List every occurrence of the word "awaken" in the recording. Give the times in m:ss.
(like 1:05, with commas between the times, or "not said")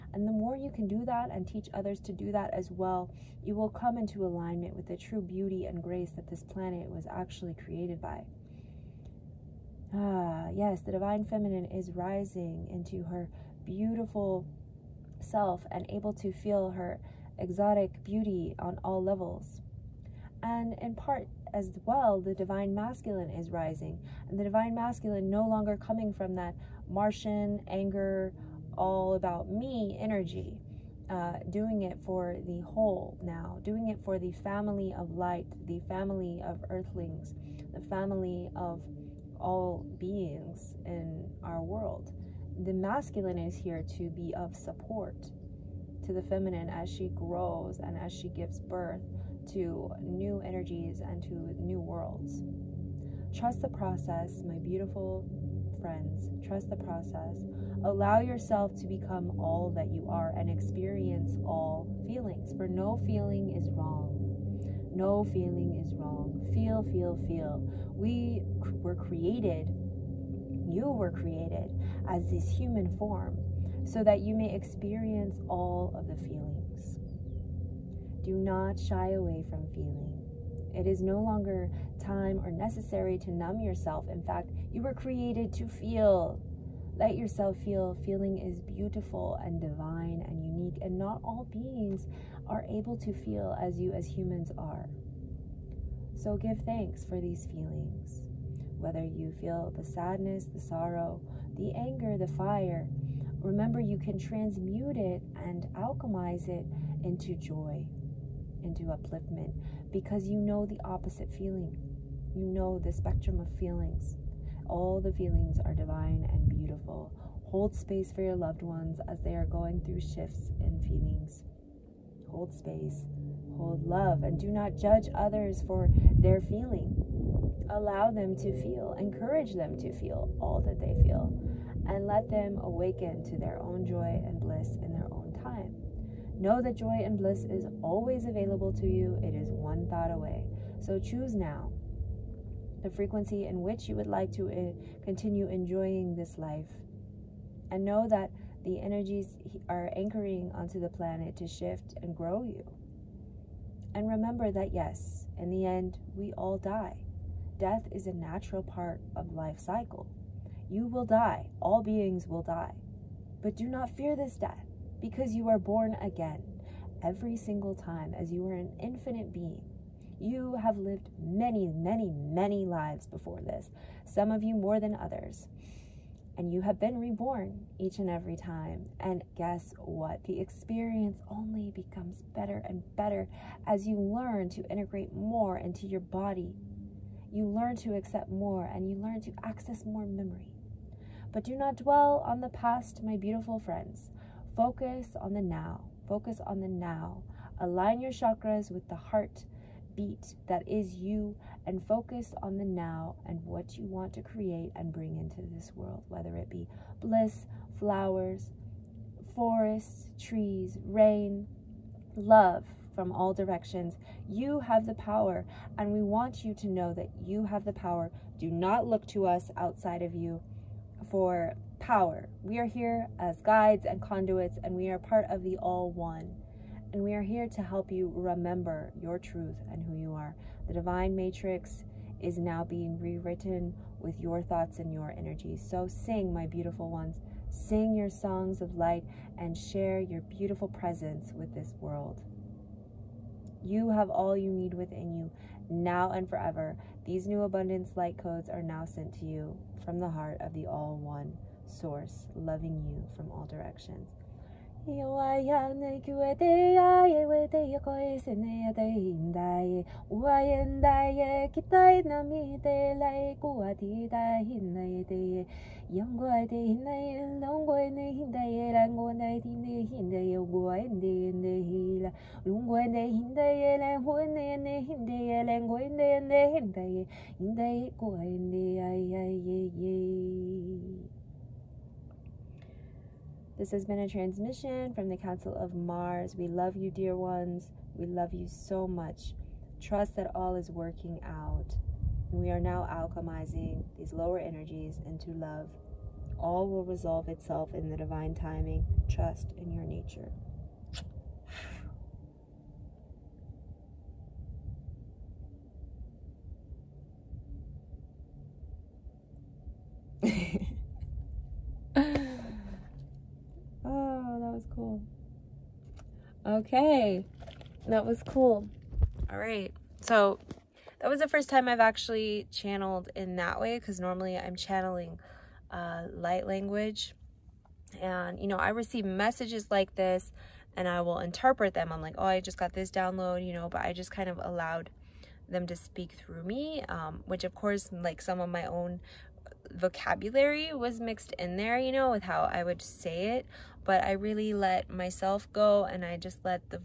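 2:12.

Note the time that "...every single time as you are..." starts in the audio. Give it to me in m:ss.
2:47.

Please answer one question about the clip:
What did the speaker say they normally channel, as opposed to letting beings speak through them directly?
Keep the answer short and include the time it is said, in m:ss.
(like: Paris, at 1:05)
Light language, at 5:26.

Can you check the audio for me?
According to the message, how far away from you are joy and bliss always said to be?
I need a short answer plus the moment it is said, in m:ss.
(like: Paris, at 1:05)
One thought away, at 2:19.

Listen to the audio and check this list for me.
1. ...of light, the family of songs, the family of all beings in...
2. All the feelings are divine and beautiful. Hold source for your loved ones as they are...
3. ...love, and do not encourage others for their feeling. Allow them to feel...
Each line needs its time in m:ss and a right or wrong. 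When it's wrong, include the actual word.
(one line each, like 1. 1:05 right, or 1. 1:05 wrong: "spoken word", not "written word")
1. 0:34 wrong: "earthlings", not "songs"
2. 1:54 wrong: "space", not "source"
3. 2:03 wrong: "judge", not "encourage".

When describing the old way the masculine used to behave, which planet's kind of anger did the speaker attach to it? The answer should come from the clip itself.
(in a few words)
Martian.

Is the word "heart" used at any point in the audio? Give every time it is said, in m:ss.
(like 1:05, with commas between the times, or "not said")
3:18, 4:10.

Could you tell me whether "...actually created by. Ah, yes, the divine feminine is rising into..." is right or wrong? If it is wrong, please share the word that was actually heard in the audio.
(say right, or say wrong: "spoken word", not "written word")
right.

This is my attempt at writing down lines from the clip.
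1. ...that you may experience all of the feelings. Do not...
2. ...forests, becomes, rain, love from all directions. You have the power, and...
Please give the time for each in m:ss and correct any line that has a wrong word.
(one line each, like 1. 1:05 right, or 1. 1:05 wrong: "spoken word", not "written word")
1. 1:14 right
2. 3:29 wrong: "trees", not "becomes".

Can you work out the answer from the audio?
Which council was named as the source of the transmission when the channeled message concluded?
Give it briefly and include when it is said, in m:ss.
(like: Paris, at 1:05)
Council of Mars, at 4:45.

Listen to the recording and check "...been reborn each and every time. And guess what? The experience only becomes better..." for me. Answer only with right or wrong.
right.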